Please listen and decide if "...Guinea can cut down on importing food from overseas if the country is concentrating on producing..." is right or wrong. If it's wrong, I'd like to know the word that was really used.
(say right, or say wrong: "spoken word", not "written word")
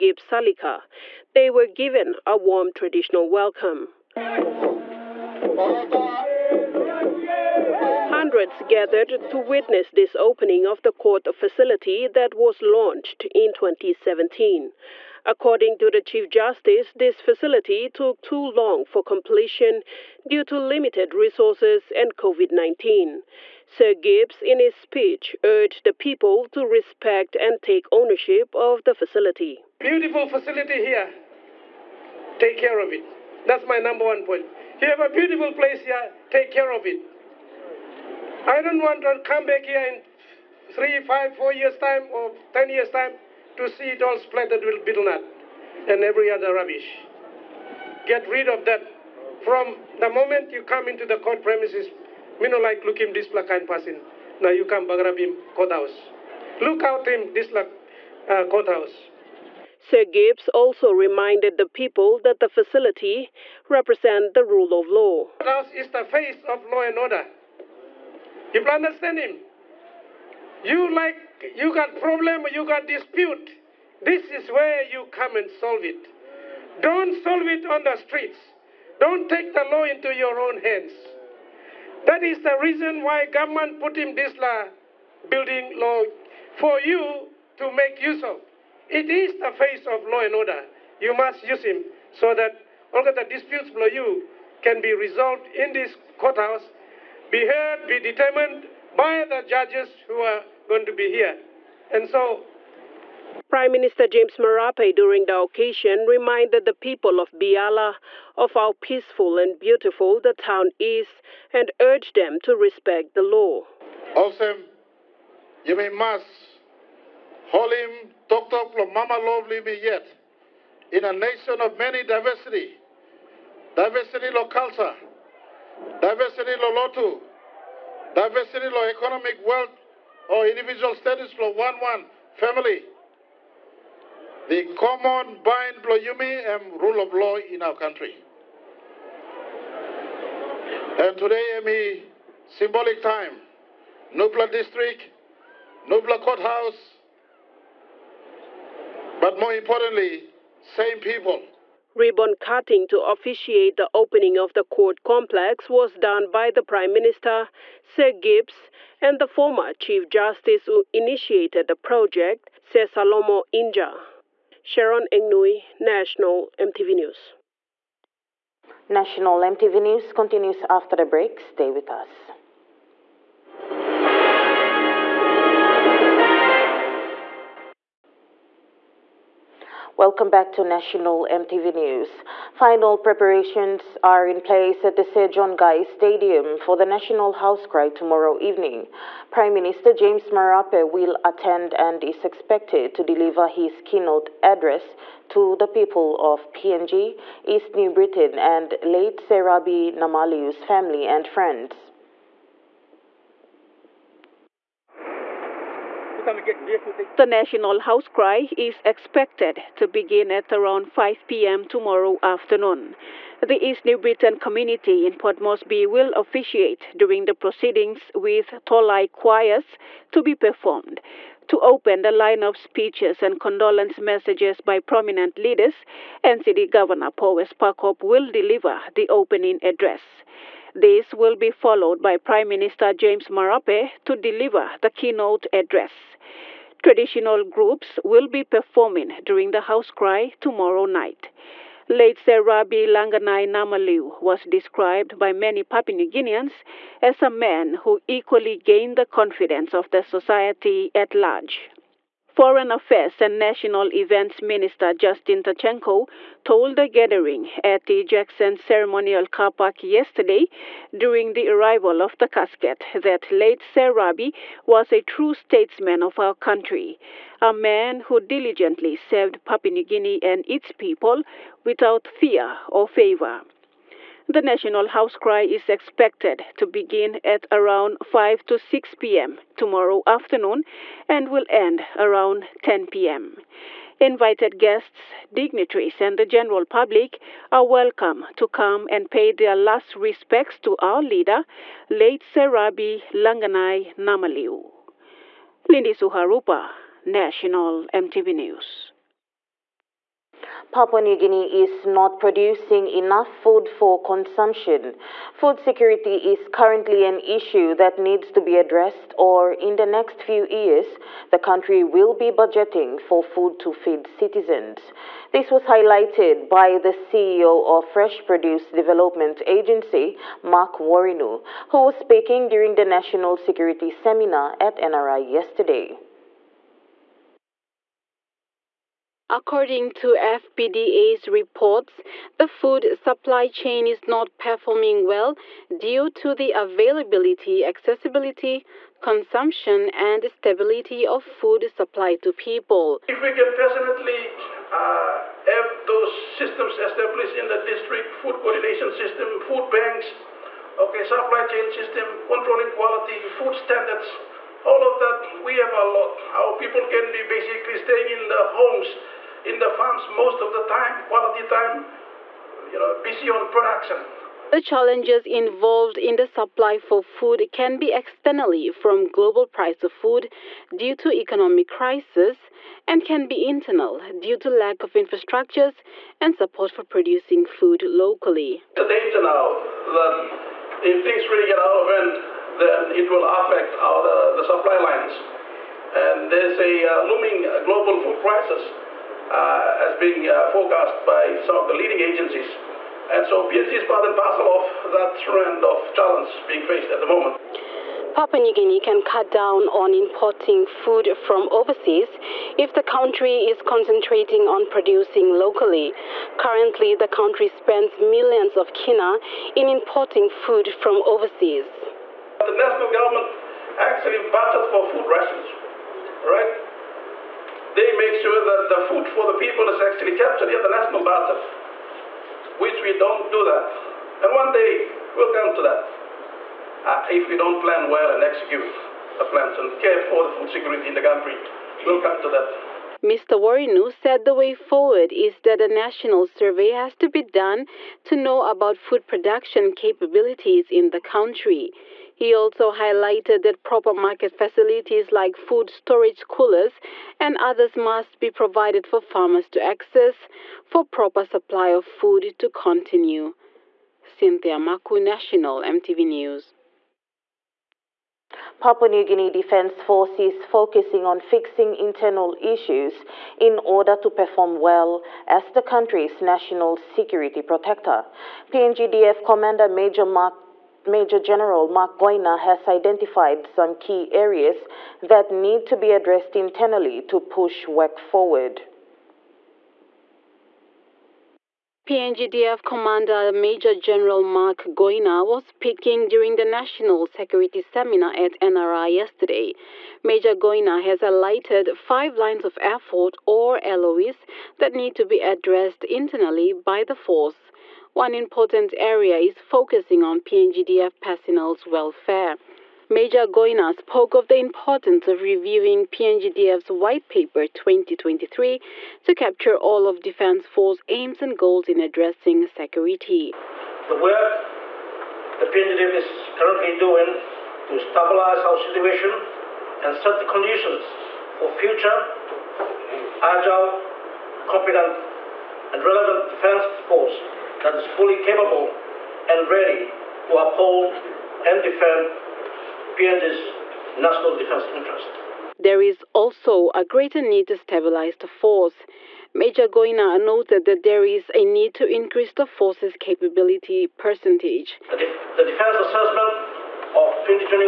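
right.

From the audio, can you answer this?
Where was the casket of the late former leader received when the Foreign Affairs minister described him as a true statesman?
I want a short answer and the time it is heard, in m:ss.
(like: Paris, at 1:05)
Jackson Ceremonial Car Park, at 4:18.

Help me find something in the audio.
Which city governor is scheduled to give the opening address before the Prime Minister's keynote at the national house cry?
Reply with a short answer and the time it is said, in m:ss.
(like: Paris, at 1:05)
Powers Parkop, at 3:47.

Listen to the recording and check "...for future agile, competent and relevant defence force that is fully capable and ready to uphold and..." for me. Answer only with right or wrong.
right.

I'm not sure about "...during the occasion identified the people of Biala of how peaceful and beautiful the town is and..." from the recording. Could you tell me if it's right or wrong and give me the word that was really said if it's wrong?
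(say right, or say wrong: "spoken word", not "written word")
wrong: "reminded", not "identified".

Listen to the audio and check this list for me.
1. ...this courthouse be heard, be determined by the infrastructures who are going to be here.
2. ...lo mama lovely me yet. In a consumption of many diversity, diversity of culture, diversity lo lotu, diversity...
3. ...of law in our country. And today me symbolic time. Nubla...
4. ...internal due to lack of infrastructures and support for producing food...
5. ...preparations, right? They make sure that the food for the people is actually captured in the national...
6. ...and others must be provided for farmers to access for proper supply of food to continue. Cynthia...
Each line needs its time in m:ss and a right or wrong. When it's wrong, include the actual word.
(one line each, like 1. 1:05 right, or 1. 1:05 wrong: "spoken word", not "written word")
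1. 1:35 wrong: "judges", not "infrastructures"
2. 1:58 wrong: "nation", not "consumption"
3. 2:17 right
4. 6:13 right
5. 6:55 wrong: "rations", not "preparations"
6. 7:27 right.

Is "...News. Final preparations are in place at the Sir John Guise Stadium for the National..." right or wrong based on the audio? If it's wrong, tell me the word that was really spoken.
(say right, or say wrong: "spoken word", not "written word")
right.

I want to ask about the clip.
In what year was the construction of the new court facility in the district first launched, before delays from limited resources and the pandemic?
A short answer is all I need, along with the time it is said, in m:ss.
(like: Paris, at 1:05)
2017, at 0:13.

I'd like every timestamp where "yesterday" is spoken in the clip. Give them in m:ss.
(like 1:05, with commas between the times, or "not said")
4:19, 5:25, 8:08.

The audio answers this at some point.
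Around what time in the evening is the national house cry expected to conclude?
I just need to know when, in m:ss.
4:42.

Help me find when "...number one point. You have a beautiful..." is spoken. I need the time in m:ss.
0:33.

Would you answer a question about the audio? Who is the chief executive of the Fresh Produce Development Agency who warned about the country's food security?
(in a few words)
Mark Worinu.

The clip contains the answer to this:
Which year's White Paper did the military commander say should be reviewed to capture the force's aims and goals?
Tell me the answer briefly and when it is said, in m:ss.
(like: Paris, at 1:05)
2023, at 8:27.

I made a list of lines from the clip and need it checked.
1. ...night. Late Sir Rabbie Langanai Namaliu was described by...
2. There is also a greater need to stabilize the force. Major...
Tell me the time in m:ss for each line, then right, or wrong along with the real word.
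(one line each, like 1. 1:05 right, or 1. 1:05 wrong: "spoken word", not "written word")
1. 4:00 right
2. 8:55 right.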